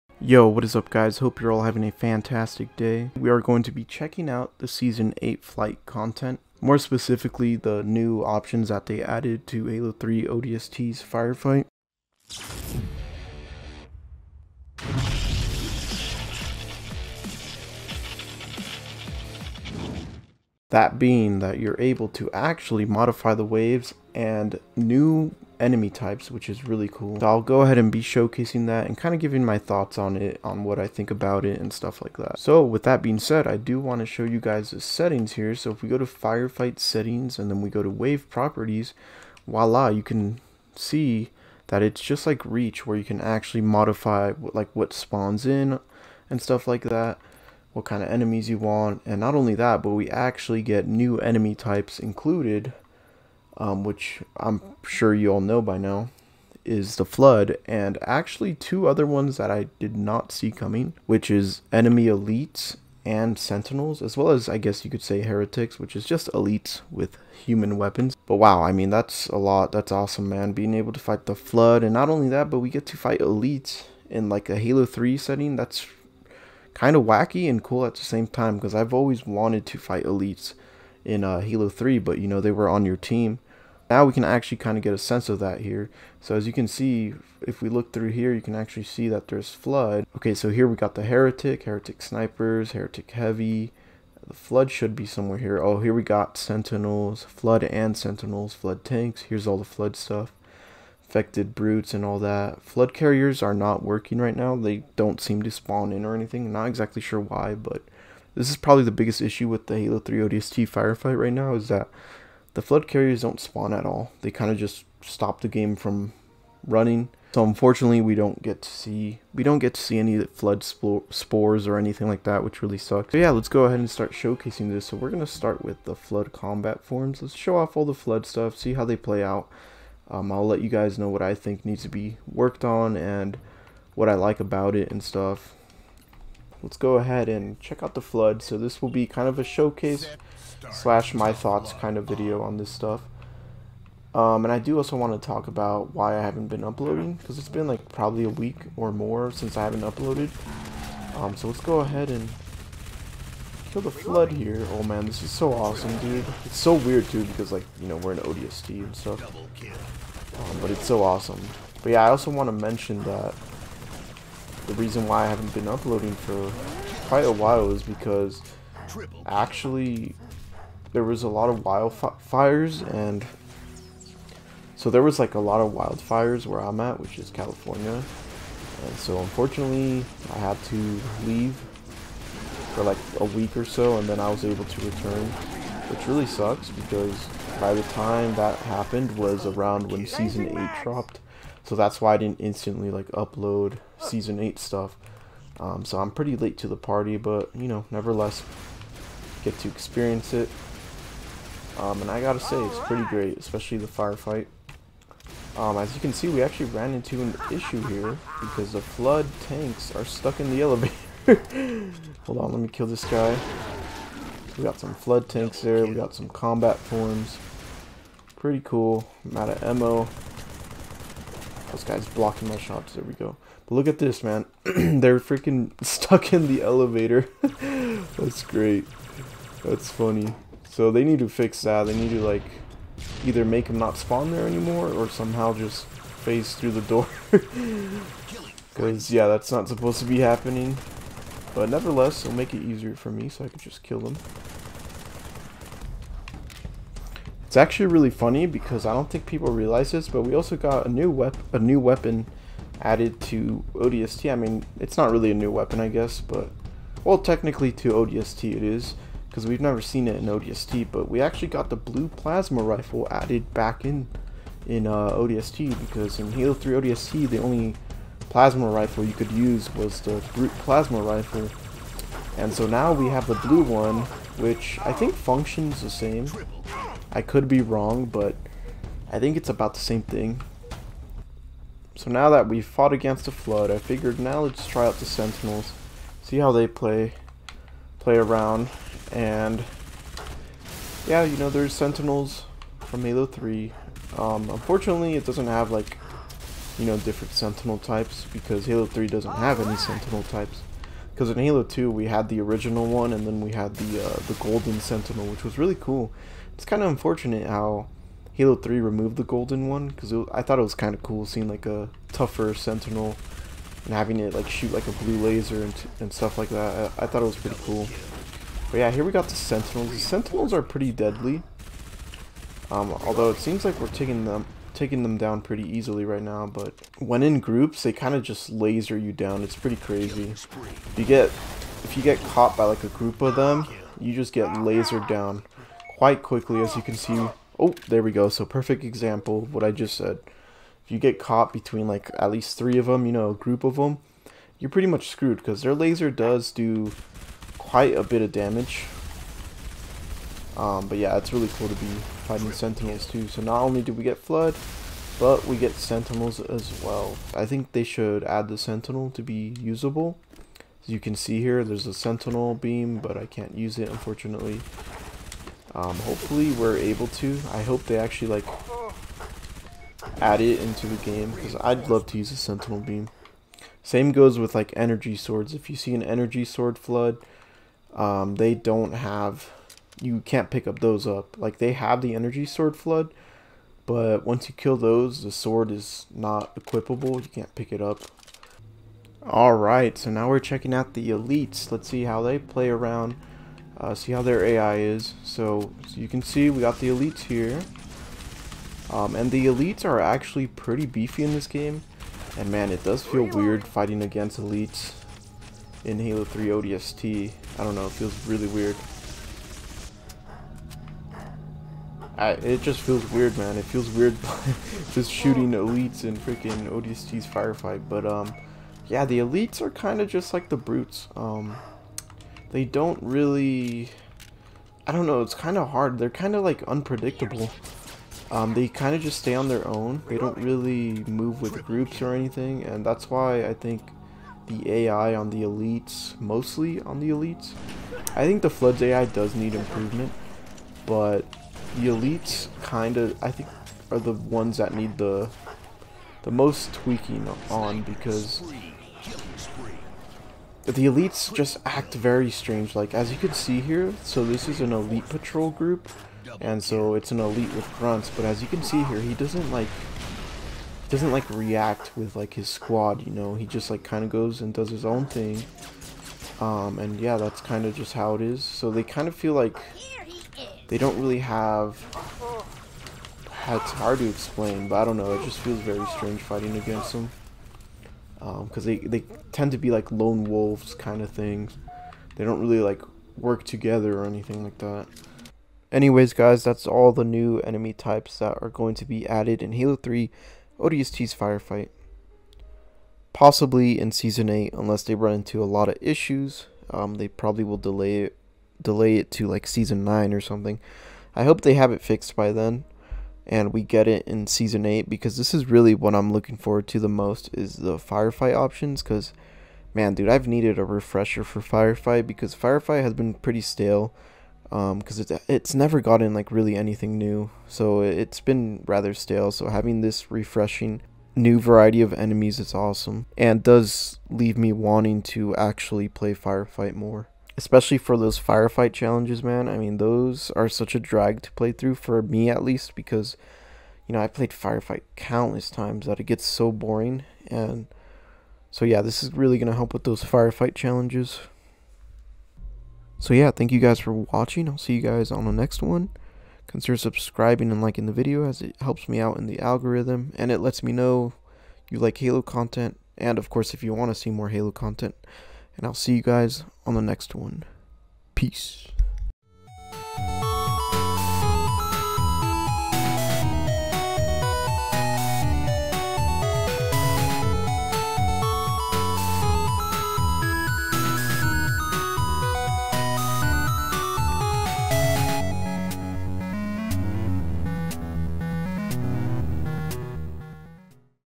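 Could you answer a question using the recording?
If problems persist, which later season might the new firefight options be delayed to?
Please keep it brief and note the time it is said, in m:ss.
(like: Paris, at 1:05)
Season 9, at 8:19.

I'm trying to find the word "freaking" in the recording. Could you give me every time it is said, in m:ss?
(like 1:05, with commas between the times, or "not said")
3:45, 6:56.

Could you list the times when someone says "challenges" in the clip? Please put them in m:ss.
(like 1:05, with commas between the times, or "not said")
8:48, 9:00.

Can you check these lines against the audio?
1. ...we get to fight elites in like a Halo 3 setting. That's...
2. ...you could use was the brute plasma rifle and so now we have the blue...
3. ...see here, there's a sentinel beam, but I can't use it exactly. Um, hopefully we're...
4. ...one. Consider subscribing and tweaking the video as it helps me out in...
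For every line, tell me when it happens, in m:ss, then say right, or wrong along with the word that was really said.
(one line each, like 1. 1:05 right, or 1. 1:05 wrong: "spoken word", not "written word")
1. 1:12 right
2. 4:29 right
3. 6:01 wrong: "unfortunately", not "exactly"
4. 9:05 wrong: "liking", not "tweaking".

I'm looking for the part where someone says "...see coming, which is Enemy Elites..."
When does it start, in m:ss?
1:00.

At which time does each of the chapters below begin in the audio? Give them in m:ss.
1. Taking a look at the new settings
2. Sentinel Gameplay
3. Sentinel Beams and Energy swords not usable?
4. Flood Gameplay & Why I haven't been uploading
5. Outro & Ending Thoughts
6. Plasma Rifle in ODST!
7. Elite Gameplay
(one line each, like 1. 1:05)
1. 0:20
2. 4:41
3. 5:57
4. 2:18
5. 8:02
6. 4:12
7. 6:28.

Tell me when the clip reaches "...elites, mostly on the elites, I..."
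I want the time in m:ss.
7:15.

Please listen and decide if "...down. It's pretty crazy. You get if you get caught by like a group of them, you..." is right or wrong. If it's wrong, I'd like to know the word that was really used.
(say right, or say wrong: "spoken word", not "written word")
right.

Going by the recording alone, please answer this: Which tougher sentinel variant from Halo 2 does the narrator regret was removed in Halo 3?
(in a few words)
Golden Sentinel.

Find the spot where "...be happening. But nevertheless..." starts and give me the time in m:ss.
4:00.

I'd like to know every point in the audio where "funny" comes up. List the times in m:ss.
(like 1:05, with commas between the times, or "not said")
3:49, 4:08.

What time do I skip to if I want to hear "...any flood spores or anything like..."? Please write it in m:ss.
1:59.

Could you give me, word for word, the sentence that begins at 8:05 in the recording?
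Anyways, guys, that's all the new enemy types that are going to be added in Halo 3 ODST's Firefight.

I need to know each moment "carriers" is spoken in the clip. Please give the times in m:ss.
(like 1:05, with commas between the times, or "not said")
1:42, 1:52.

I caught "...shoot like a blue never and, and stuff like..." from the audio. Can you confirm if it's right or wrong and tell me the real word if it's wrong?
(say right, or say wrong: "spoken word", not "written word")
wrong: "laser", not "never".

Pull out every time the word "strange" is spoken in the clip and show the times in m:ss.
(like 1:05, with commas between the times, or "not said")
7:32, 7:55.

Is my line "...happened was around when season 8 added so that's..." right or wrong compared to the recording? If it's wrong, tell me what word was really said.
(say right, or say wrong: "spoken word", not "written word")
wrong: "dropped", not "added".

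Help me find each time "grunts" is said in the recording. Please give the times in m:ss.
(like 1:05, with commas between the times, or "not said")
7:37.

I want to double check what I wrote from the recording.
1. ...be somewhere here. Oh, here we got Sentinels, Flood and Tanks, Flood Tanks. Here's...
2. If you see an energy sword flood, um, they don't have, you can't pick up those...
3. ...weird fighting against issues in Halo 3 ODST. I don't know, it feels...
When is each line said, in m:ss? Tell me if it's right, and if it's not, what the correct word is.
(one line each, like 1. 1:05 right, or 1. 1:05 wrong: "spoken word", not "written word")
1. 1:34 wrong: "Sentinels", not "Tanks"
2. 6:15 right
3. 6:43 wrong: "elites", not "issues".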